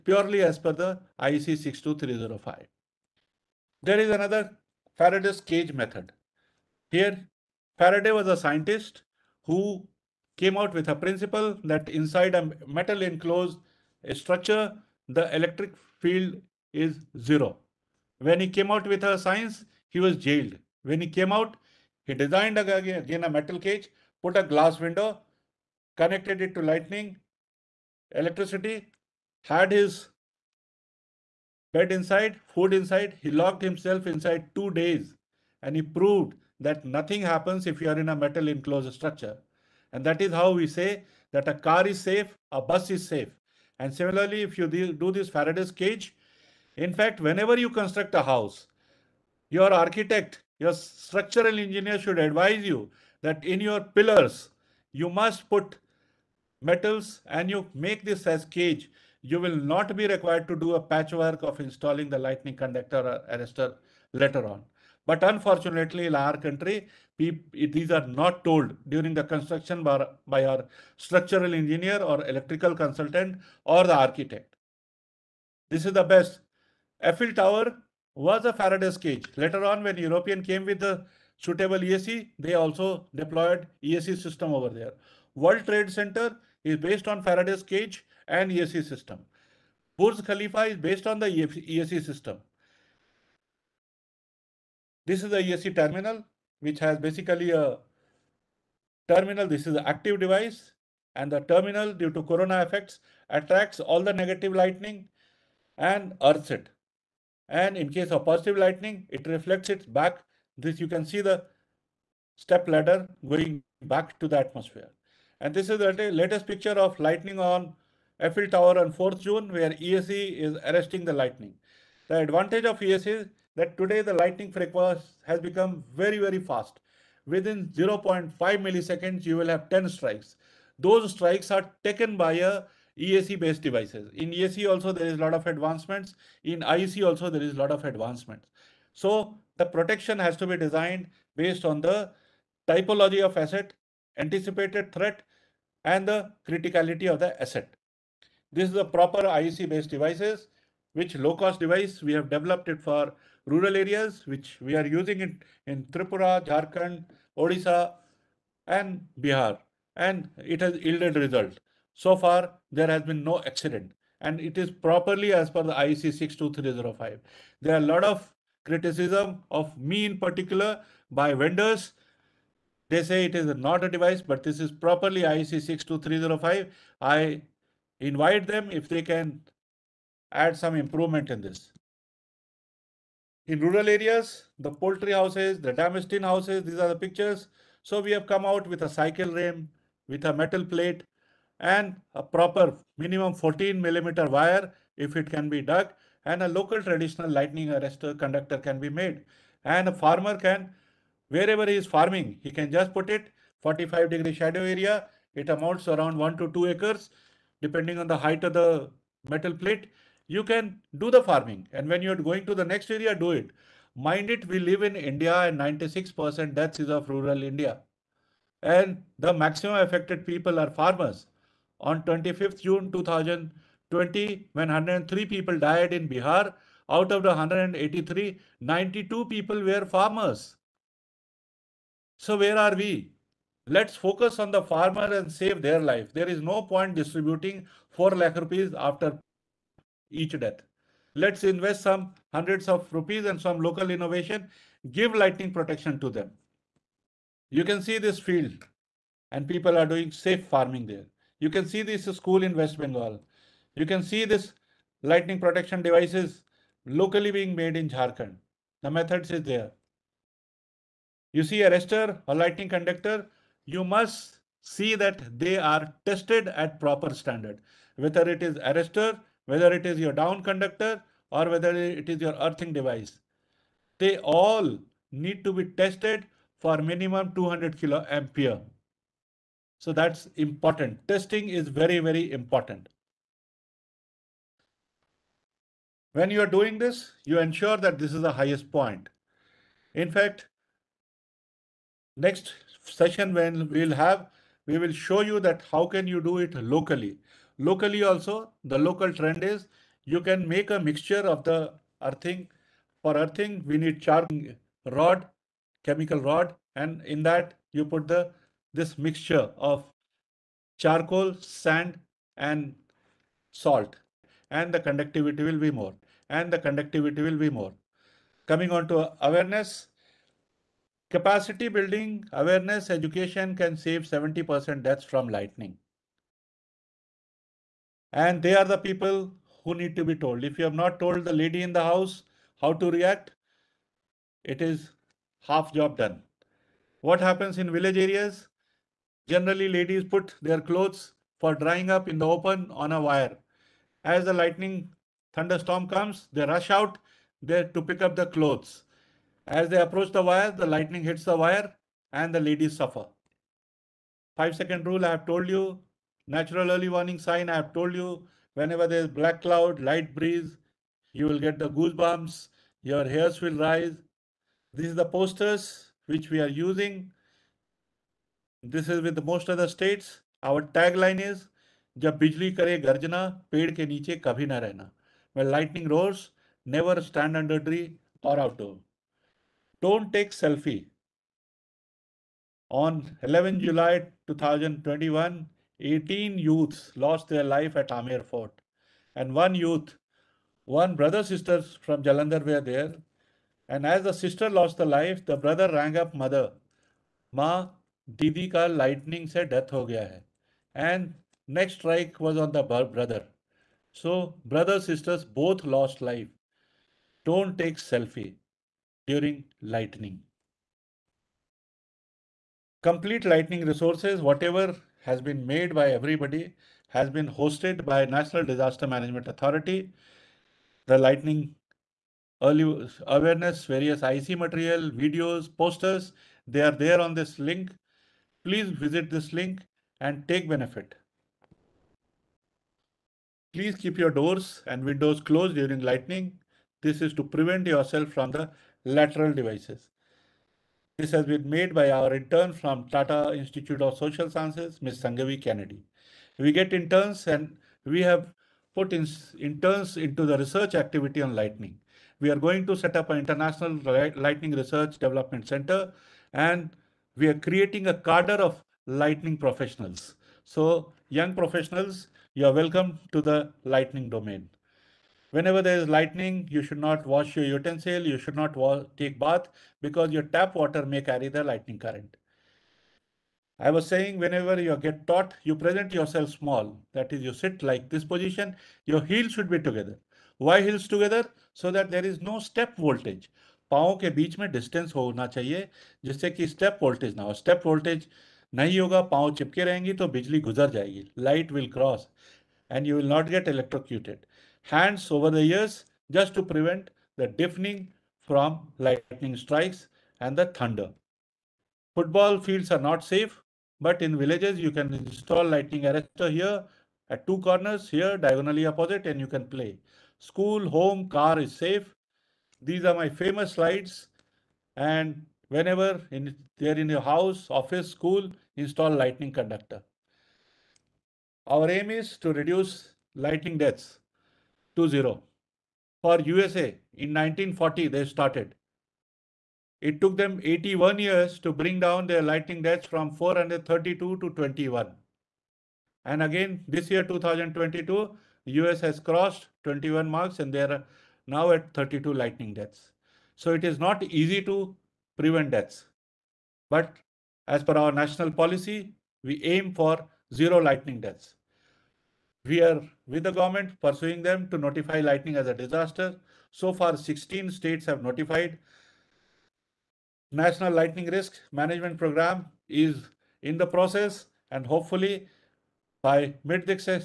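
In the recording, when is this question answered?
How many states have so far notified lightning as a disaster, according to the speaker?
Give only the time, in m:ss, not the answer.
9:16.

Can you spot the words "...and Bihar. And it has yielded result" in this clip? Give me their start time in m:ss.
2:38.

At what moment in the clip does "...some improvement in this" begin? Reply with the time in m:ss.
3:00.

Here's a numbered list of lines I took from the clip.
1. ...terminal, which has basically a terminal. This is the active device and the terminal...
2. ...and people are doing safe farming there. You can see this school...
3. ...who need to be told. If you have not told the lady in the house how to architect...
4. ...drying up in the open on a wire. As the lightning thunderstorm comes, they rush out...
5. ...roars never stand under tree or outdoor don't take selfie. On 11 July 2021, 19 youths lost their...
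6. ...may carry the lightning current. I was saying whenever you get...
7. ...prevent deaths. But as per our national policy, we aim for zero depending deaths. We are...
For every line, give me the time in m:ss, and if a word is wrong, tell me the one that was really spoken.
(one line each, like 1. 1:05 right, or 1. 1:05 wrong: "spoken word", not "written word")
1. 1:35 right
2. 4:09 right
3. 5:29 wrong: "react", not "architect"
4. 5:41 right
5. 6:15 wrong: "18", not "19"
6. 7:50 right
7. 9:05 wrong: "lightning", not "depending".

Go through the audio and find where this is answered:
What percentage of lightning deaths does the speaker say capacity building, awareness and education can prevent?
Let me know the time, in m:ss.
5:24.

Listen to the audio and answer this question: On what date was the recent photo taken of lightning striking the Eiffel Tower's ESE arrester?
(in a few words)
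4th June.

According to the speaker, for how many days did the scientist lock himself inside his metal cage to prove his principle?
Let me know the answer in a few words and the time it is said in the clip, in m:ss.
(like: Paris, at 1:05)
2, at 0:34.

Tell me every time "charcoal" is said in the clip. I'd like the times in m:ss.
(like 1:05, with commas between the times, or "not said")
5:04, 5:10.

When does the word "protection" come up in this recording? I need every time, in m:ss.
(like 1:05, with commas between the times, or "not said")
2:19, 4:05, 4:15.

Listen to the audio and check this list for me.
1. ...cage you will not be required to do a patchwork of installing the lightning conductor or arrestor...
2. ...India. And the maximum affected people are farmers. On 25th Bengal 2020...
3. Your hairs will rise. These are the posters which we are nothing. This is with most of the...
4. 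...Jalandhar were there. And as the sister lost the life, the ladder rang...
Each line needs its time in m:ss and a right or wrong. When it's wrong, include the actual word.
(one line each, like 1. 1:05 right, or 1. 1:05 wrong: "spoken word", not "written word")
1. 0:58 right
2. 3:37 wrong: "June", not "Bengal"
3. 6:02 wrong: "using", not "nothing"
4. 6:32 wrong: "brother", not "ladder".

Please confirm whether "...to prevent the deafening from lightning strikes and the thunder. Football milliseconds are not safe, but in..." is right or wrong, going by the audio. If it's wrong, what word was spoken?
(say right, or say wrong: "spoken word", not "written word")
wrong: "fields", not "milliseconds".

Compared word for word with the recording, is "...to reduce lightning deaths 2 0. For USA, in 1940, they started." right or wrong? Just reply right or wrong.
right.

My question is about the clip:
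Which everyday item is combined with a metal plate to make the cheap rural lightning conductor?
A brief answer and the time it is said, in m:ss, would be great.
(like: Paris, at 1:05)
cycle rim, at 3:08.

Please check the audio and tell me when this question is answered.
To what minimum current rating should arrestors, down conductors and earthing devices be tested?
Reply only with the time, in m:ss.
4:37.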